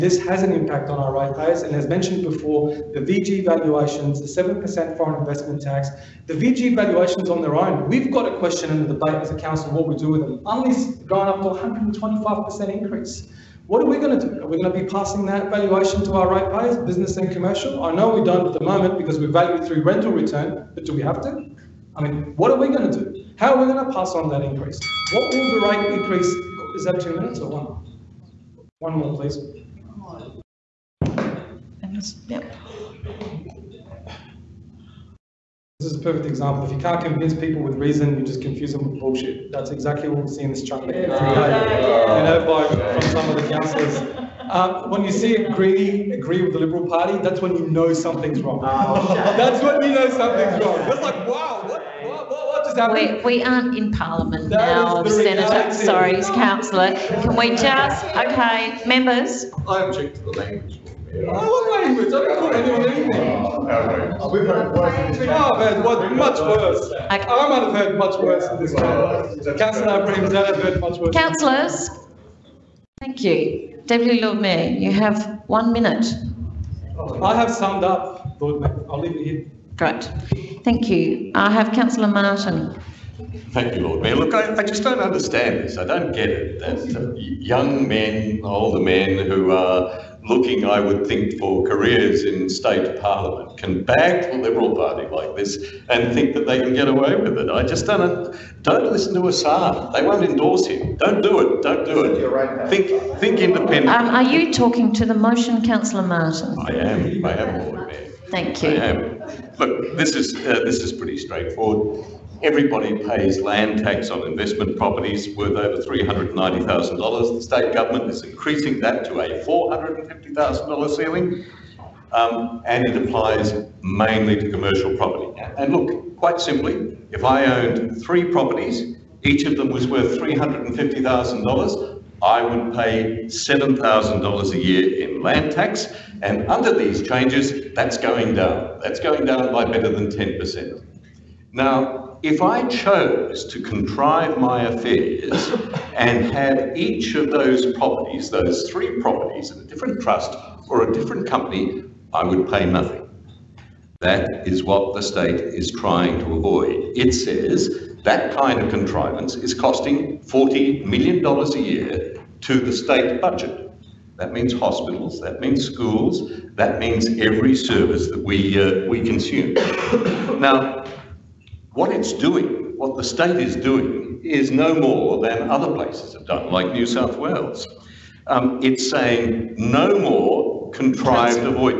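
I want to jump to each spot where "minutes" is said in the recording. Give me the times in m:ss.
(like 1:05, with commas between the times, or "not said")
0:27, 1:15.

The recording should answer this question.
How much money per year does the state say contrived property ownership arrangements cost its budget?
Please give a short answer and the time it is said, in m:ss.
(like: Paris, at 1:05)
$40 million, at 2:40.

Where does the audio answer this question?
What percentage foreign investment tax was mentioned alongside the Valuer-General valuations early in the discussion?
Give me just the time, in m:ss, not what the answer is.
0:04.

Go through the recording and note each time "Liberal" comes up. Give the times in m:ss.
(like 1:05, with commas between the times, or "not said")
0:46, 1:34.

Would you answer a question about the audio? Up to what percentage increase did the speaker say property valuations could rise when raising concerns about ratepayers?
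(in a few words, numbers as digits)
125%.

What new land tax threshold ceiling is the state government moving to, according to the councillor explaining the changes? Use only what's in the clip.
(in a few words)
$450,000.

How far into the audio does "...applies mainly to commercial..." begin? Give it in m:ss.
2:02.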